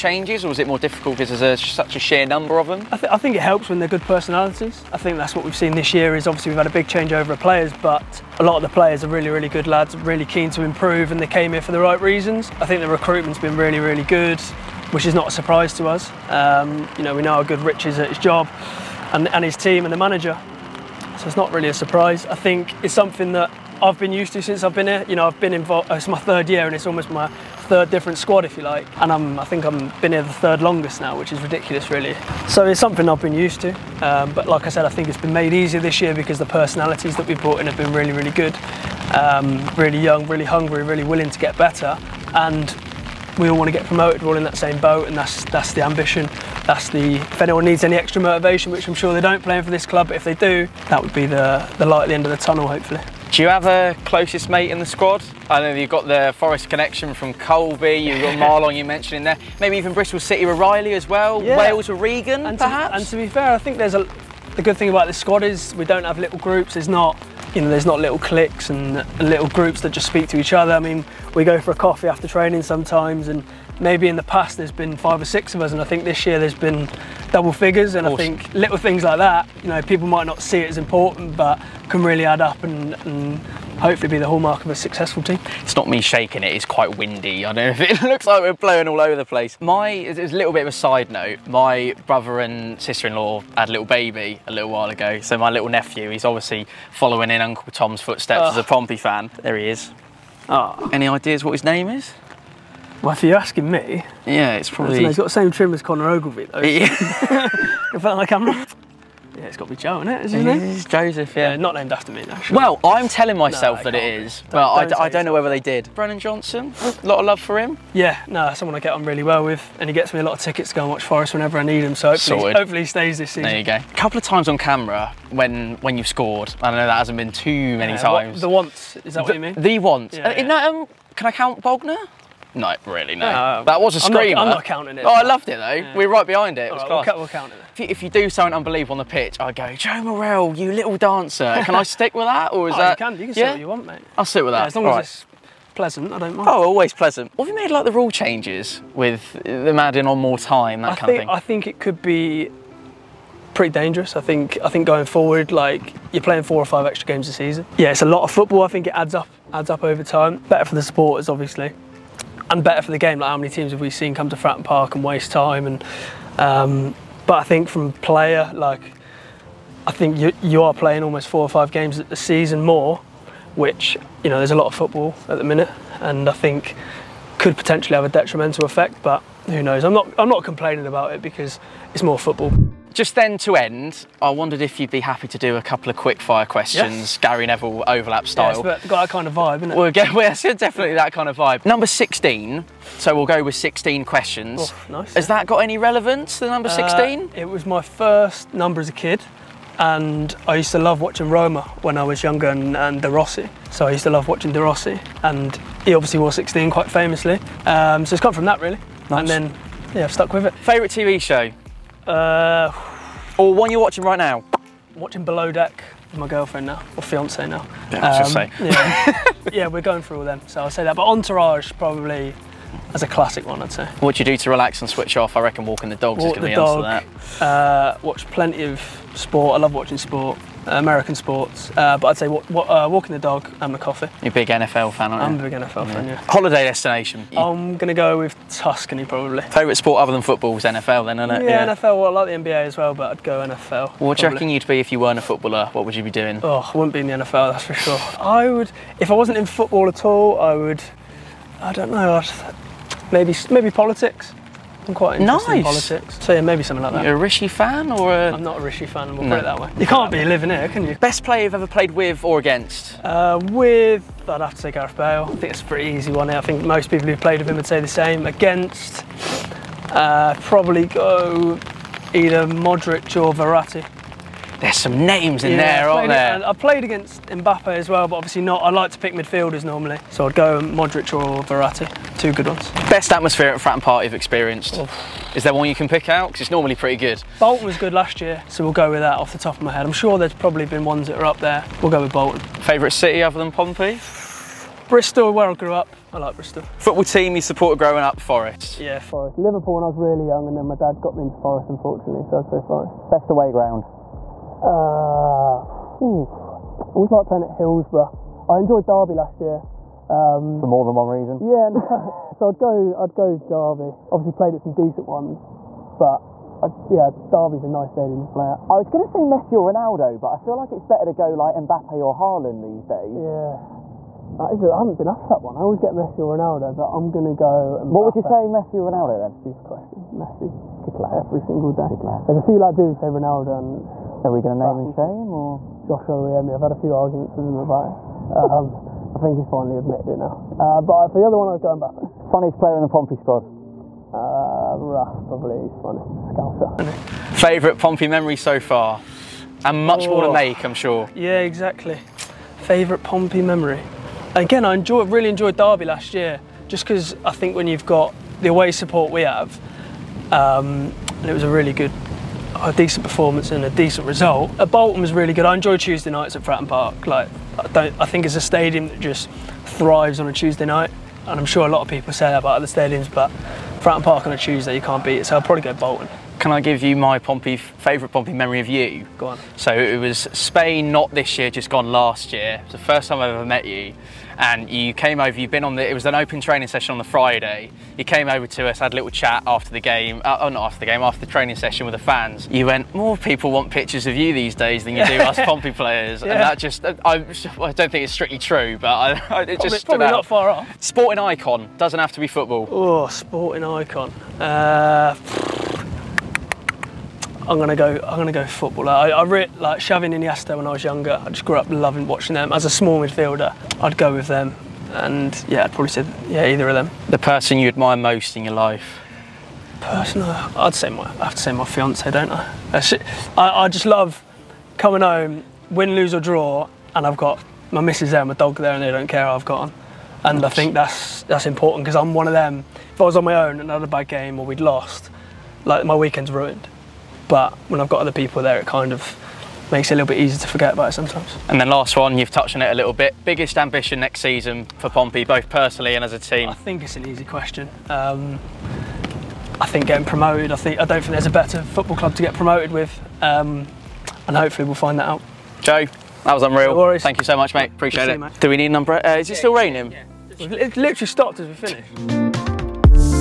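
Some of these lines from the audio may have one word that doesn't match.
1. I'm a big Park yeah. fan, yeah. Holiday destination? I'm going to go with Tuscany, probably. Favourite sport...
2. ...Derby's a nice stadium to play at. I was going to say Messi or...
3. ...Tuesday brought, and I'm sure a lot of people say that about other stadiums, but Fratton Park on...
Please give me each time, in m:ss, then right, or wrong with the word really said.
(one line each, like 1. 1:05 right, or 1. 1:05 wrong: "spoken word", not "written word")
1. 3:55 wrong: "NFL", not "Park"
2. 5:17 right
3. 6:10 wrong: "night", not "brought".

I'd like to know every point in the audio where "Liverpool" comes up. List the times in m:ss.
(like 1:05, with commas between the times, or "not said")
4:59.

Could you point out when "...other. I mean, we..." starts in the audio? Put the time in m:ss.
1:10.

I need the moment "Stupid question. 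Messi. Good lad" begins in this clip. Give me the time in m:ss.
5:29.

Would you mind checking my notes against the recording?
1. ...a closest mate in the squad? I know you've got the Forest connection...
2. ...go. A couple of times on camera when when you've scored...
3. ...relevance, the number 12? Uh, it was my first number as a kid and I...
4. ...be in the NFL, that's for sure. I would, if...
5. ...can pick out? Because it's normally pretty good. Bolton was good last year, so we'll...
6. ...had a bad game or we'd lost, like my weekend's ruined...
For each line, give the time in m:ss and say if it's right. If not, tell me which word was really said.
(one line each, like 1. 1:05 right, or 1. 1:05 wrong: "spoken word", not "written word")
1. 0:53 right
2. 2:03 right
3. 3:15 wrong: "16", not "12"
4. 4:06 right
5. 4:45 right
6. 7:13 right.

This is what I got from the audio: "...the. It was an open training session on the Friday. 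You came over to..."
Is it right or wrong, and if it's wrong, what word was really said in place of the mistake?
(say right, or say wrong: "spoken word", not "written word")
right.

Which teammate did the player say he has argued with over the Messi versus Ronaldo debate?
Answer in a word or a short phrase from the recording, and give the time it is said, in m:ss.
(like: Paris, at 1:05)
Josh Oluwayemi, at 5:35.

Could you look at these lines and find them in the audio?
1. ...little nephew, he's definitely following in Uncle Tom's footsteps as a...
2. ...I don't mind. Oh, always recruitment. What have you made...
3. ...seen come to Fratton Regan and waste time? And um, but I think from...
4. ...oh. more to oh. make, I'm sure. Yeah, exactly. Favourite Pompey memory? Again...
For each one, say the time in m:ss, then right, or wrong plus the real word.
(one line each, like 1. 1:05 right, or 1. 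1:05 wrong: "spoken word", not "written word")
1. 1:35 wrong: "obviously", not "definitely"
2. 2:26 wrong: "pleasant", not "recruitment"
3. 2:43 wrong: "Park", not "Regan"
4. 5:50 right.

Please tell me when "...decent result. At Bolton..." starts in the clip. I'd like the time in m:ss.
6:03.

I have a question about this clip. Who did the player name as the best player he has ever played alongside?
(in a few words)
Gareth Bale.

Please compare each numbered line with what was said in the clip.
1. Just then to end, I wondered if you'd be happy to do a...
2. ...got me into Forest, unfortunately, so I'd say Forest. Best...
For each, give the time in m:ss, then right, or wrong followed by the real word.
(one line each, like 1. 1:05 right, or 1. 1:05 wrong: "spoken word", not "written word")
1. 3:02 right
2. 5:00 right.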